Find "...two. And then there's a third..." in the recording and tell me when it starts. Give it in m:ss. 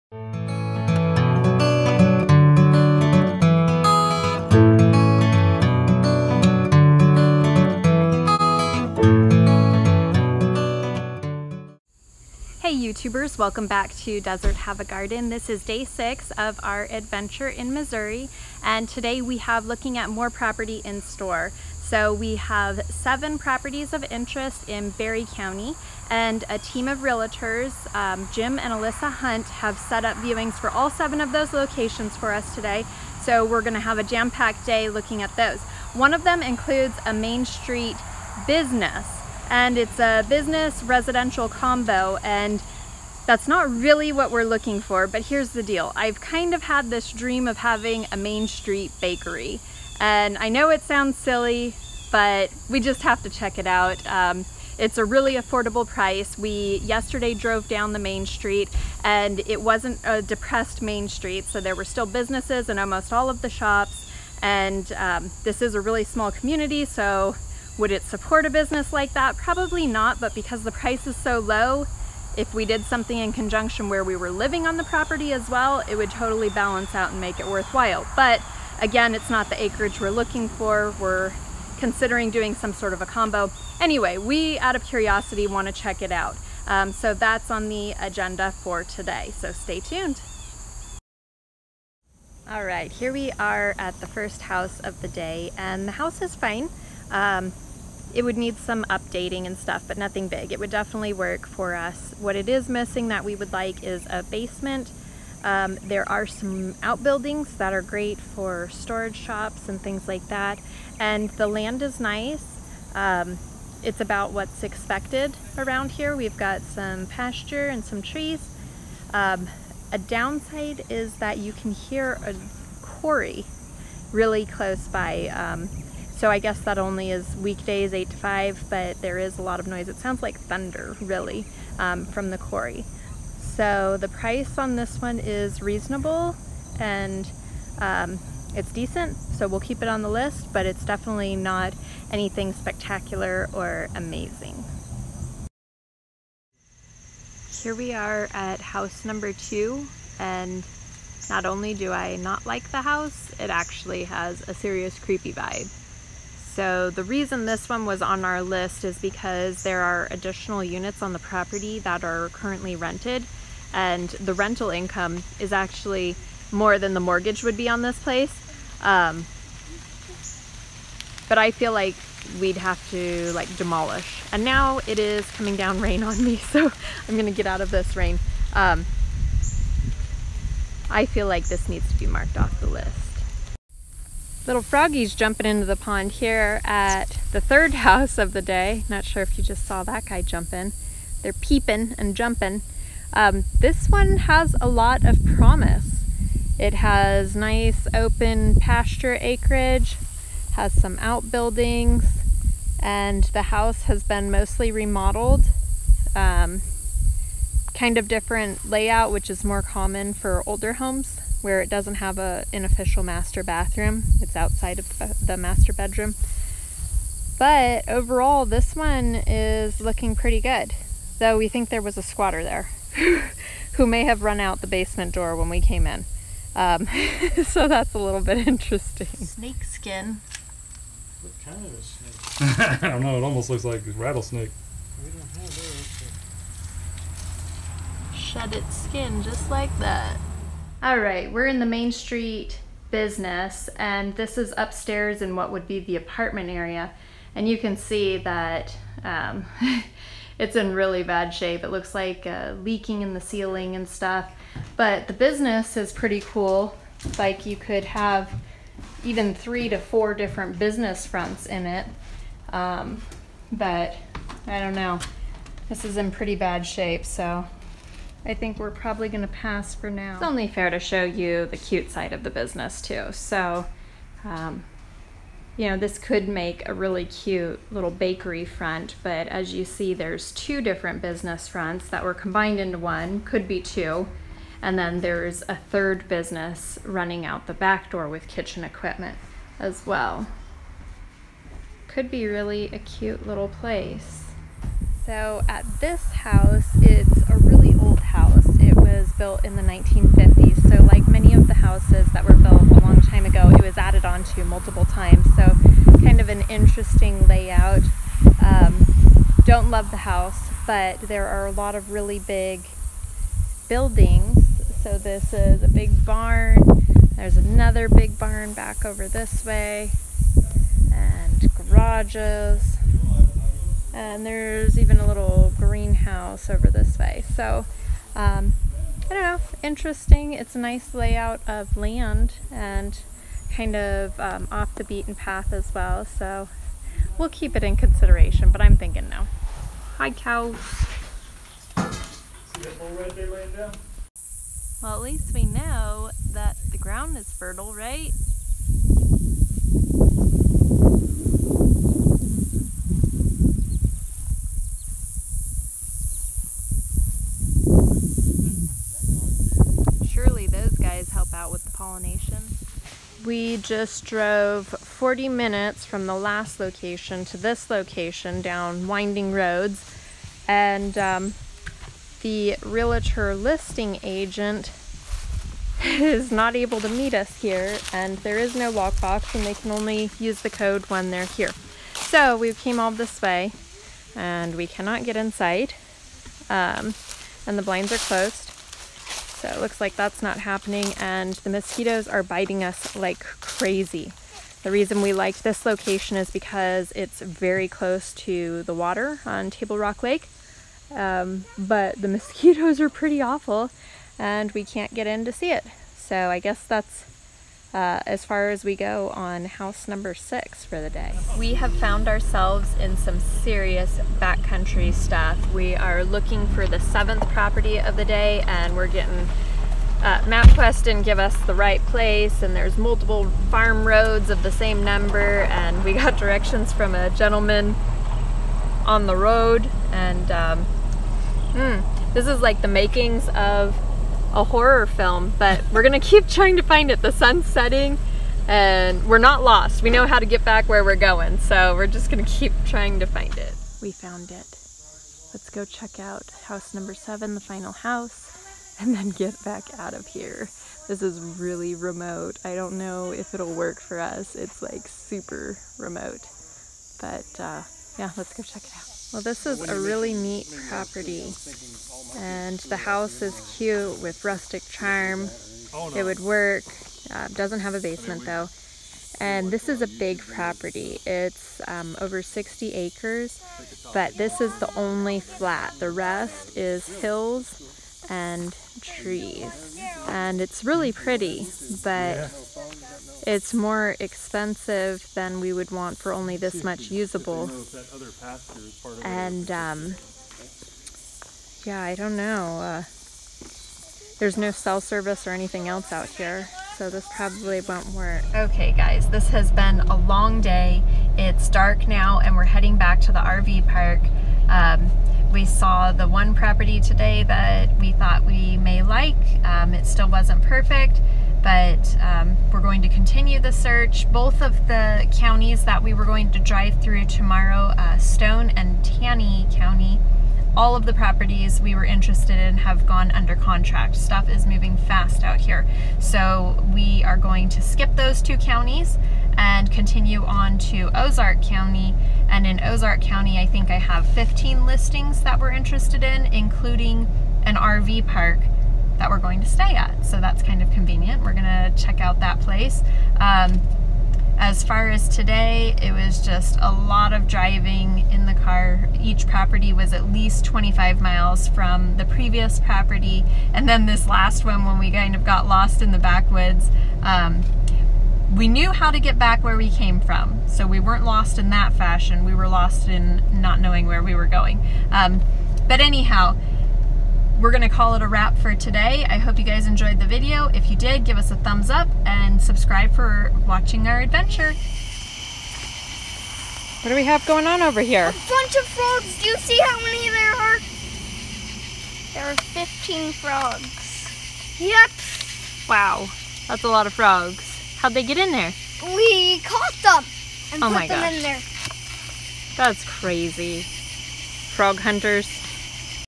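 4:43.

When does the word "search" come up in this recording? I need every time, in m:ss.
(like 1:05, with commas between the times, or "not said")
8:33.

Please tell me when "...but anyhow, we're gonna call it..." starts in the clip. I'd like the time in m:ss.
9:25.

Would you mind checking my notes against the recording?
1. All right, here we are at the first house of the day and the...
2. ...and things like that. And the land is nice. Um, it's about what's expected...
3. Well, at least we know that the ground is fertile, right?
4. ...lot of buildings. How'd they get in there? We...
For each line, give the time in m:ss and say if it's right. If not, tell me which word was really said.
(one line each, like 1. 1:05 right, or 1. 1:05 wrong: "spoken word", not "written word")
1. 1:32 right
2. 1:49 right
3. 5:44 right
4. 9:46 wrong: "frogs", not "buildings".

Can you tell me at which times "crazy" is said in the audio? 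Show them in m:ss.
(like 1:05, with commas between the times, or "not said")
6:33, 9:52.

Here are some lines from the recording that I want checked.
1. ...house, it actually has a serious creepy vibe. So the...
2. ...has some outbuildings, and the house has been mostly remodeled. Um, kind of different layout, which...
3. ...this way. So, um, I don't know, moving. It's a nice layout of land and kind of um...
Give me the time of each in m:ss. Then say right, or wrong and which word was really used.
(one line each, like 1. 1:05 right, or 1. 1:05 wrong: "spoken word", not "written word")
1. 2:32 right
2. 3:20 right
3. 5:26 wrong: "interesting", not "moving".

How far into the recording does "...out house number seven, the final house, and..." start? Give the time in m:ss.
7:25.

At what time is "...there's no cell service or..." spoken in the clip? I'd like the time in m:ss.
8:14.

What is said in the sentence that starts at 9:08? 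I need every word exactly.
Each property was at least 25 miles from the previous property.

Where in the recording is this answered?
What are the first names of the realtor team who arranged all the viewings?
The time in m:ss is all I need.
0:28.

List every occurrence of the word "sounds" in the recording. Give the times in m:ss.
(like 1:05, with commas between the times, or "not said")
0:50, 2:09.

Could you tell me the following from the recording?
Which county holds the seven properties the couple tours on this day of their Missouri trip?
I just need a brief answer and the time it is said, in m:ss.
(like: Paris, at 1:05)
Barry County, at 0:24.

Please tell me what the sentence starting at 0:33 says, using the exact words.
So we're gonna have a jam-packed day looking at those.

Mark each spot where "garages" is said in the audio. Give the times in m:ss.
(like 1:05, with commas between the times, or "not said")
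5:21.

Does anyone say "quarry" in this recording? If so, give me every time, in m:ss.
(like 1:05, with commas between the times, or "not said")
2:02, 2:12.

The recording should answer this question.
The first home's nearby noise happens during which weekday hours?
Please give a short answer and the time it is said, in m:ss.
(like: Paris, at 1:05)
8 to 5, at 2:07.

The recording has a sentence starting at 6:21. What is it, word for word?
So we came all this way, and we cannot get inside, um, and the blinds are closed.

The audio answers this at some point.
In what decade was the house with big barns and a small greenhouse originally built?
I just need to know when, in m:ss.
4:59.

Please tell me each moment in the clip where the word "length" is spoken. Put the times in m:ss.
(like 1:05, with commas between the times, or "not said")
not said.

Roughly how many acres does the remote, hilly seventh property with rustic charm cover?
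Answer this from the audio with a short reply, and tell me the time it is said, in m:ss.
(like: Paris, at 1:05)
Over 60 acres, at 7:51.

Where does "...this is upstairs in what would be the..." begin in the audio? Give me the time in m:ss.
4:04.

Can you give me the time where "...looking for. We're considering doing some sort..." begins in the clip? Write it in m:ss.
1:20.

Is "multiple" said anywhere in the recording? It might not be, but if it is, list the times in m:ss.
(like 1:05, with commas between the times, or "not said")
5:04, 7:02.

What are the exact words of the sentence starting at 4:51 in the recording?
Could be really a cute little place.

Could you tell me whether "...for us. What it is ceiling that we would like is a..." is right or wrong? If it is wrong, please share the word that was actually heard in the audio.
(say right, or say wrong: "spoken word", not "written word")
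wrong: "missing", not "ceiling".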